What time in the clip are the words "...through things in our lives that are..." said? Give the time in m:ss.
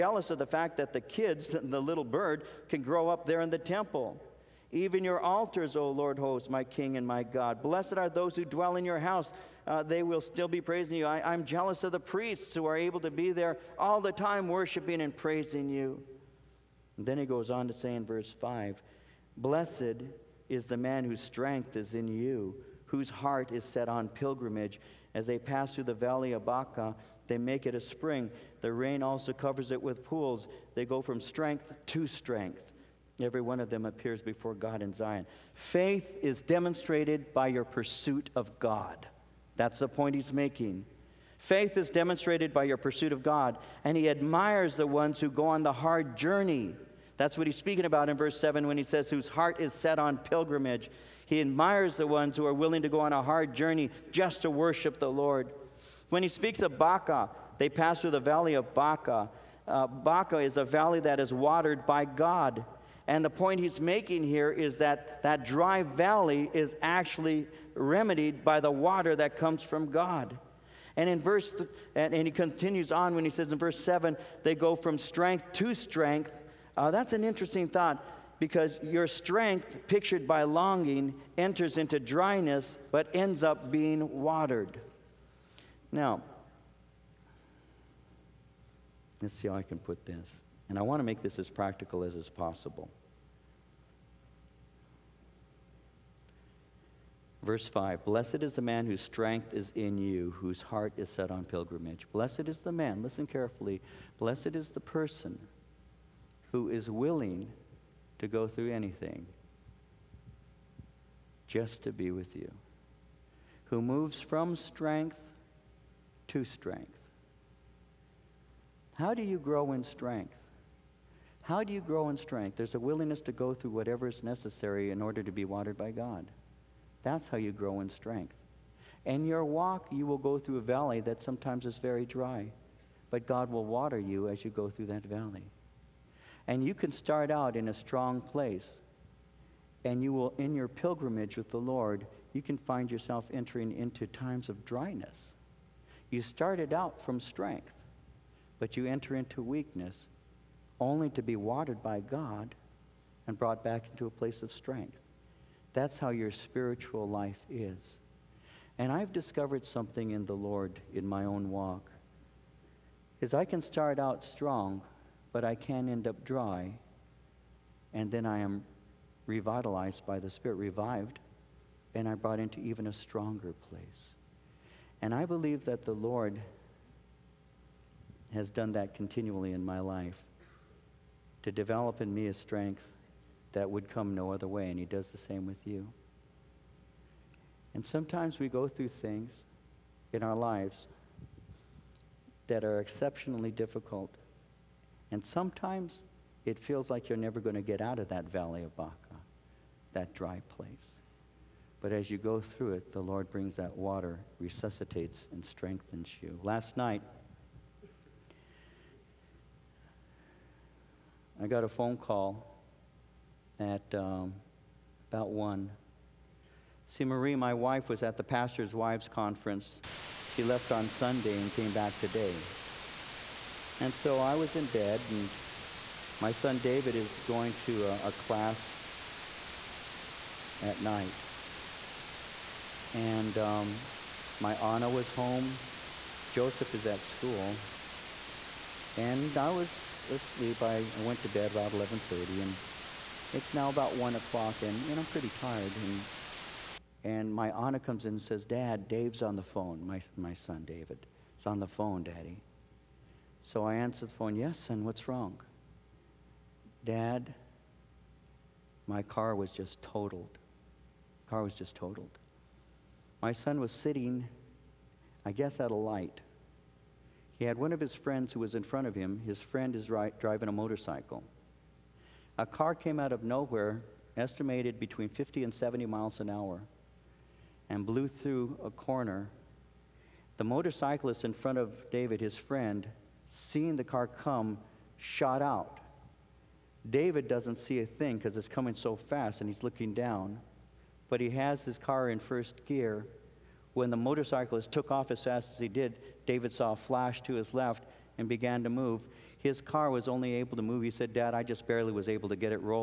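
3:08.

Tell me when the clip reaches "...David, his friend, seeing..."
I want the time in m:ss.
4:41.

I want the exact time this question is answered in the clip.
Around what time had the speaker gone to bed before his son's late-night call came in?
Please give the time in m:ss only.
4:01.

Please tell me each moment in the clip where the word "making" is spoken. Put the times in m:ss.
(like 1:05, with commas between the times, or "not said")
0:40, 1:03.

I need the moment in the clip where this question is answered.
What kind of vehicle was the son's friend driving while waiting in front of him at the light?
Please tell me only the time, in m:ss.
4:30.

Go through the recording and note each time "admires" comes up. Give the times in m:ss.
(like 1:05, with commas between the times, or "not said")
0:44, 0:51.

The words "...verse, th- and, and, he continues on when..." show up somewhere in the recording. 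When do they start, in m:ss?
1:11.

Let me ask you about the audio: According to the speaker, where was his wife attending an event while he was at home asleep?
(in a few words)
pastor's wives' conference.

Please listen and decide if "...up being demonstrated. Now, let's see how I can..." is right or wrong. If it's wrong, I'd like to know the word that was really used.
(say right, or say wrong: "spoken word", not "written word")
wrong: "watered", not "demonstrated".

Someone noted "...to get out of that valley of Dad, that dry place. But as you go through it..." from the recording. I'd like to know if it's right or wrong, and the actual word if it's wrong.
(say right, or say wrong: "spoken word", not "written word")
wrong: "Baca", not "Dad".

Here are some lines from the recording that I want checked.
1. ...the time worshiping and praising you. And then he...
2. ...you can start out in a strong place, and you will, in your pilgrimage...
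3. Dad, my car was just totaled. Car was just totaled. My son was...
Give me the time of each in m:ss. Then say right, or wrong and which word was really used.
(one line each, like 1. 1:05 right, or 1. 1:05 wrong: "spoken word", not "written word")
1. 0:14 right
2. 2:16 right
3. 4:16 right.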